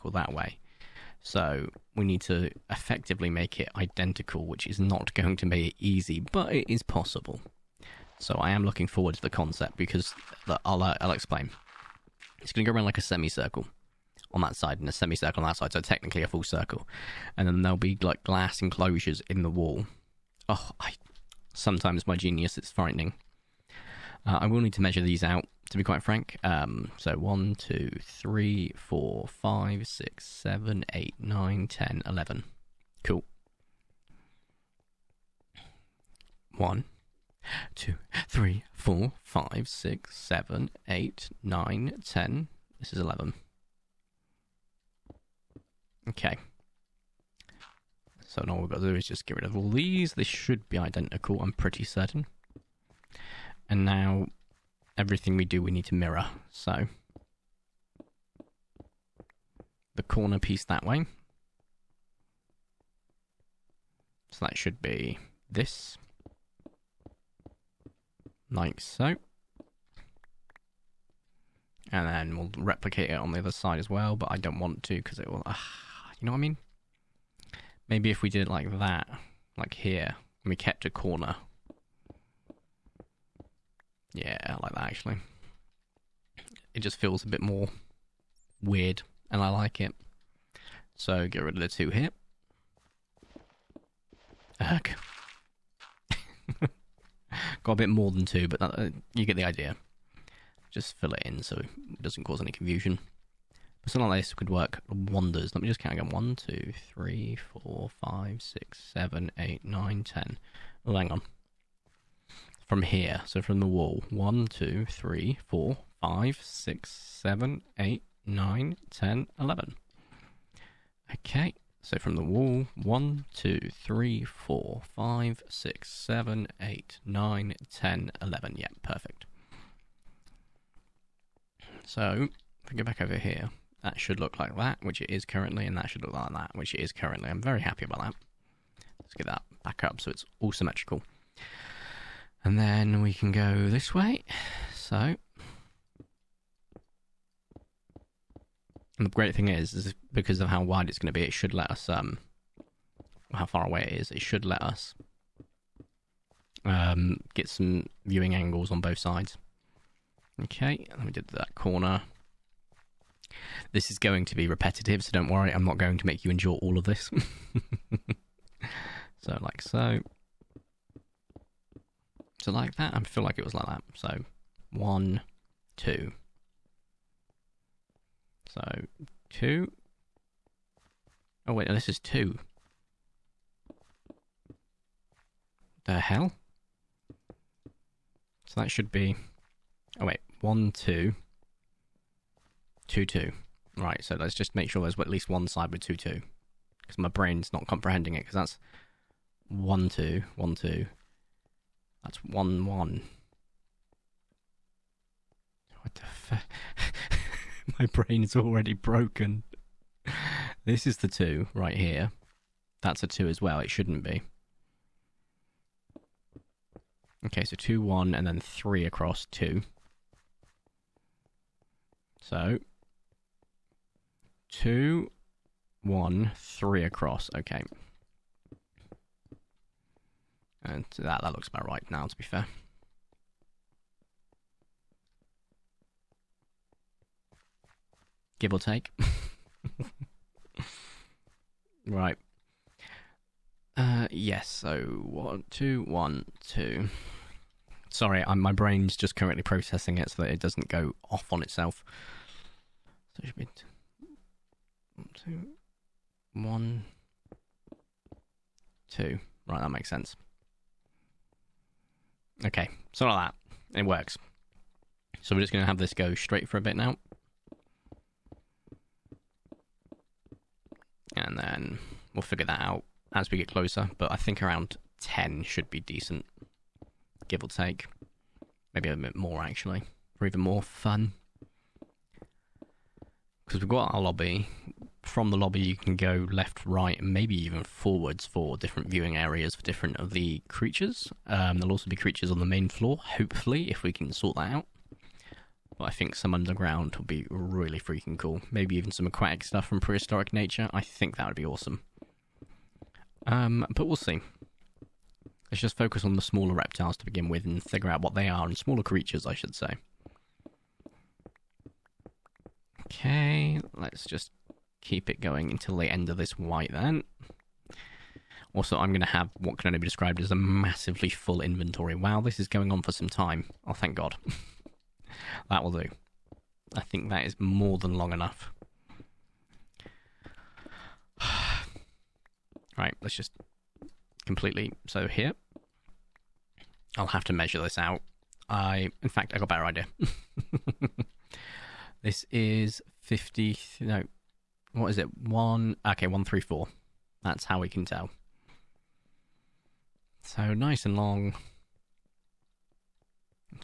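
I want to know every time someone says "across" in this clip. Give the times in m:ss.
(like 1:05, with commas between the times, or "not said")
3:38, 3:46.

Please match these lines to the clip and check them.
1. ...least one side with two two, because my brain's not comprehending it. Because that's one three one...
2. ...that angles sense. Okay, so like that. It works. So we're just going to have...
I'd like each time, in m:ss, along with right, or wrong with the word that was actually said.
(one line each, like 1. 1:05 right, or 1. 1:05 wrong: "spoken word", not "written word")
1. 3:15 wrong: "two", not "three"
2. 4:19 wrong: "makes", not "angles".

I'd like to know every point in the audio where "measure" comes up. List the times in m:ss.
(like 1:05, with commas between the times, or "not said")
0:24, 5:37.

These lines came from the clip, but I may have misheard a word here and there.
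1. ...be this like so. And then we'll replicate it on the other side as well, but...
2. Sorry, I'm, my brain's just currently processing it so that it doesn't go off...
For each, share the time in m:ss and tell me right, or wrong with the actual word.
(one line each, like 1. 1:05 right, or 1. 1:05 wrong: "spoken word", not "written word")
1. 1:04 right
2. 4:07 right.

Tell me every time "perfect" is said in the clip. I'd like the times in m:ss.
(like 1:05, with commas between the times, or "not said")
2:08.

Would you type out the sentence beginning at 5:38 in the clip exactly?
I, in fact, I got a better idea.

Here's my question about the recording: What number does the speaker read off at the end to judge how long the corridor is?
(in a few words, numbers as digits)
134.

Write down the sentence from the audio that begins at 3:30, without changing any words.
This is the two right here.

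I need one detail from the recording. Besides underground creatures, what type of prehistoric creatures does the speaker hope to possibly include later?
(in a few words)
aquatic.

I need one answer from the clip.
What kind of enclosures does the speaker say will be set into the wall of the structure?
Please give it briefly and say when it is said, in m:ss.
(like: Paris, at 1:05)
glass enclosures, at 0:18.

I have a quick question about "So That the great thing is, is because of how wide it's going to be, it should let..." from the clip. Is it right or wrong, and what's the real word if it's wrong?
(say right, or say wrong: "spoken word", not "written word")
wrong: "And", not "That".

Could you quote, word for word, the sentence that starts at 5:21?
Wow, this is going on for some time.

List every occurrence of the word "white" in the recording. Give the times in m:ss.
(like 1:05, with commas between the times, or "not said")
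5:16.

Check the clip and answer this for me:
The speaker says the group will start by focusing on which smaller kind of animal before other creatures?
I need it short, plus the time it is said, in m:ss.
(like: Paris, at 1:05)
reptiles, at 5:06.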